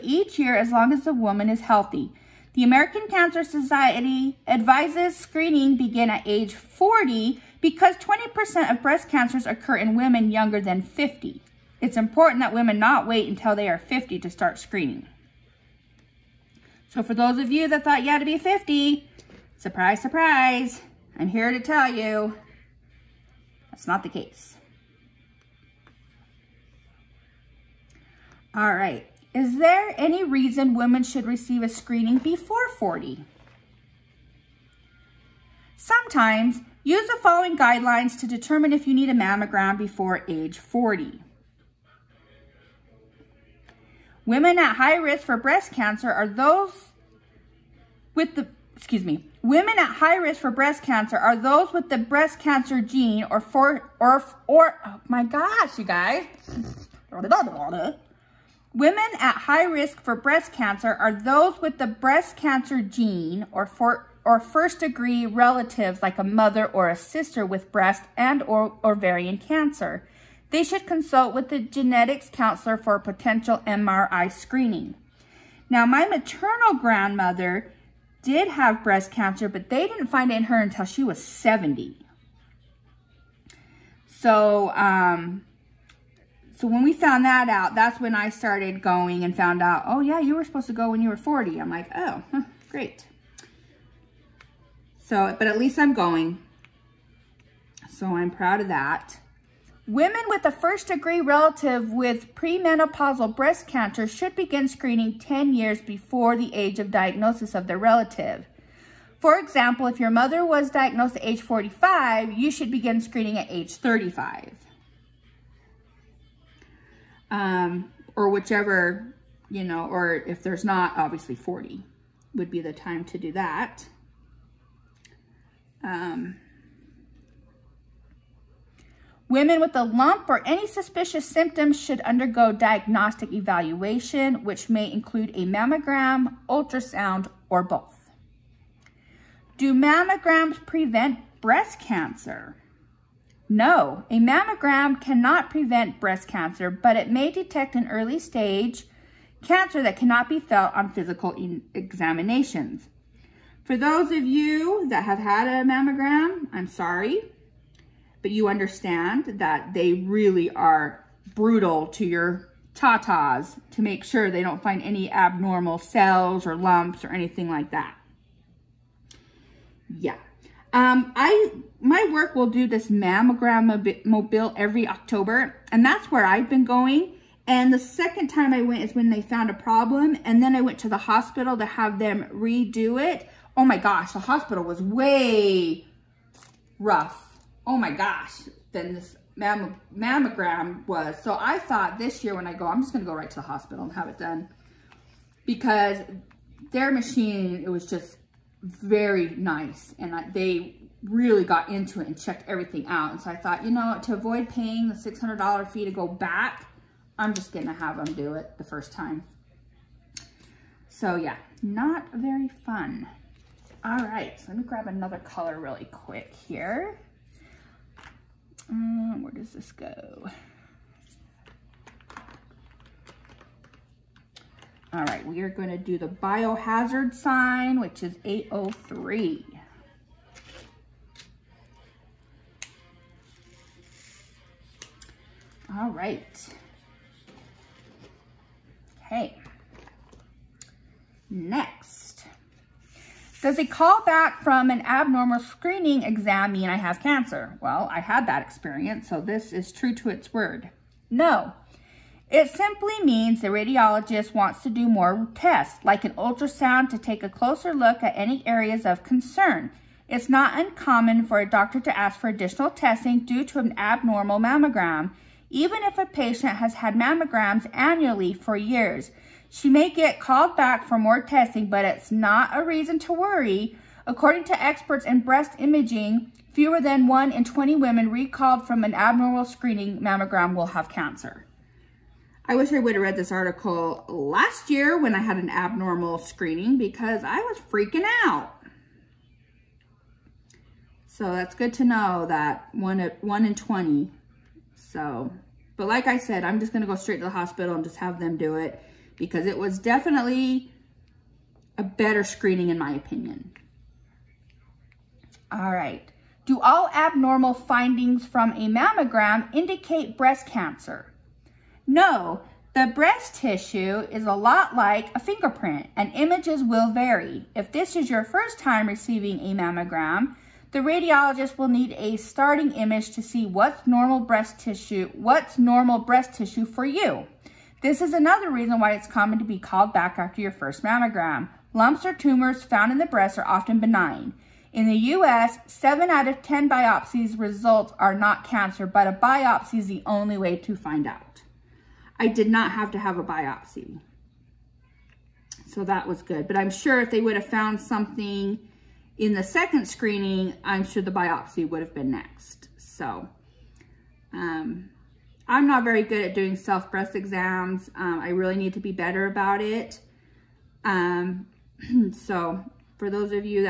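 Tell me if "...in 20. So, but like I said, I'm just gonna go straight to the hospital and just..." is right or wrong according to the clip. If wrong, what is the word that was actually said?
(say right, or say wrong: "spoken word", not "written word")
right.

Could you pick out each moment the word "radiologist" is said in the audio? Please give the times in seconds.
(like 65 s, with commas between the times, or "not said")
253 s, 320 s.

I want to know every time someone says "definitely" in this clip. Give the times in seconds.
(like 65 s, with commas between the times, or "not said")
299 s.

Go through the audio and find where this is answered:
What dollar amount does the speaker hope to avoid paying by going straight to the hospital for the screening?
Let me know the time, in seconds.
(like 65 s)
204 s.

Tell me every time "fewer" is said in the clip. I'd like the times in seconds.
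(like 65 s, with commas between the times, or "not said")
276 s.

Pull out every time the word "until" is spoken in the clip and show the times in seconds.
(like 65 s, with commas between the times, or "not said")
13 s, 80 s.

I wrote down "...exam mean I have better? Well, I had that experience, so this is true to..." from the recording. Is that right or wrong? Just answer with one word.
wrong.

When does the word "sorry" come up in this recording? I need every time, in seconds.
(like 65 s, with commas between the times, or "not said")
156 s.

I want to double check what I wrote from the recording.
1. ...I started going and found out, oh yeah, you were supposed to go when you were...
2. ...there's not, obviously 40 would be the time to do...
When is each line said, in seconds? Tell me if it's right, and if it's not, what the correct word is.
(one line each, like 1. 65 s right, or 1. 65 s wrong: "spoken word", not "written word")
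1. 88 s right
2. 120 s right.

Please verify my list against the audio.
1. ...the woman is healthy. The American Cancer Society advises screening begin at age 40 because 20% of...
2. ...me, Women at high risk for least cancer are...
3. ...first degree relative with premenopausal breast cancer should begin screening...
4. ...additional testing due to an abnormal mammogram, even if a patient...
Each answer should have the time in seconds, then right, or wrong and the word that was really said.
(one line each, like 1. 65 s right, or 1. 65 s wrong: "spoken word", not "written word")
1. 1 s right
2. 49 s wrong: "breast", not "least"
3. 100 s right
4. 262 s right.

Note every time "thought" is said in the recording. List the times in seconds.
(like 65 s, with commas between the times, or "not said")
17 s, 191 s, 203 s.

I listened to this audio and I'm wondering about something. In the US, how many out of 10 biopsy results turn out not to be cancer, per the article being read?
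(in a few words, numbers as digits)
7.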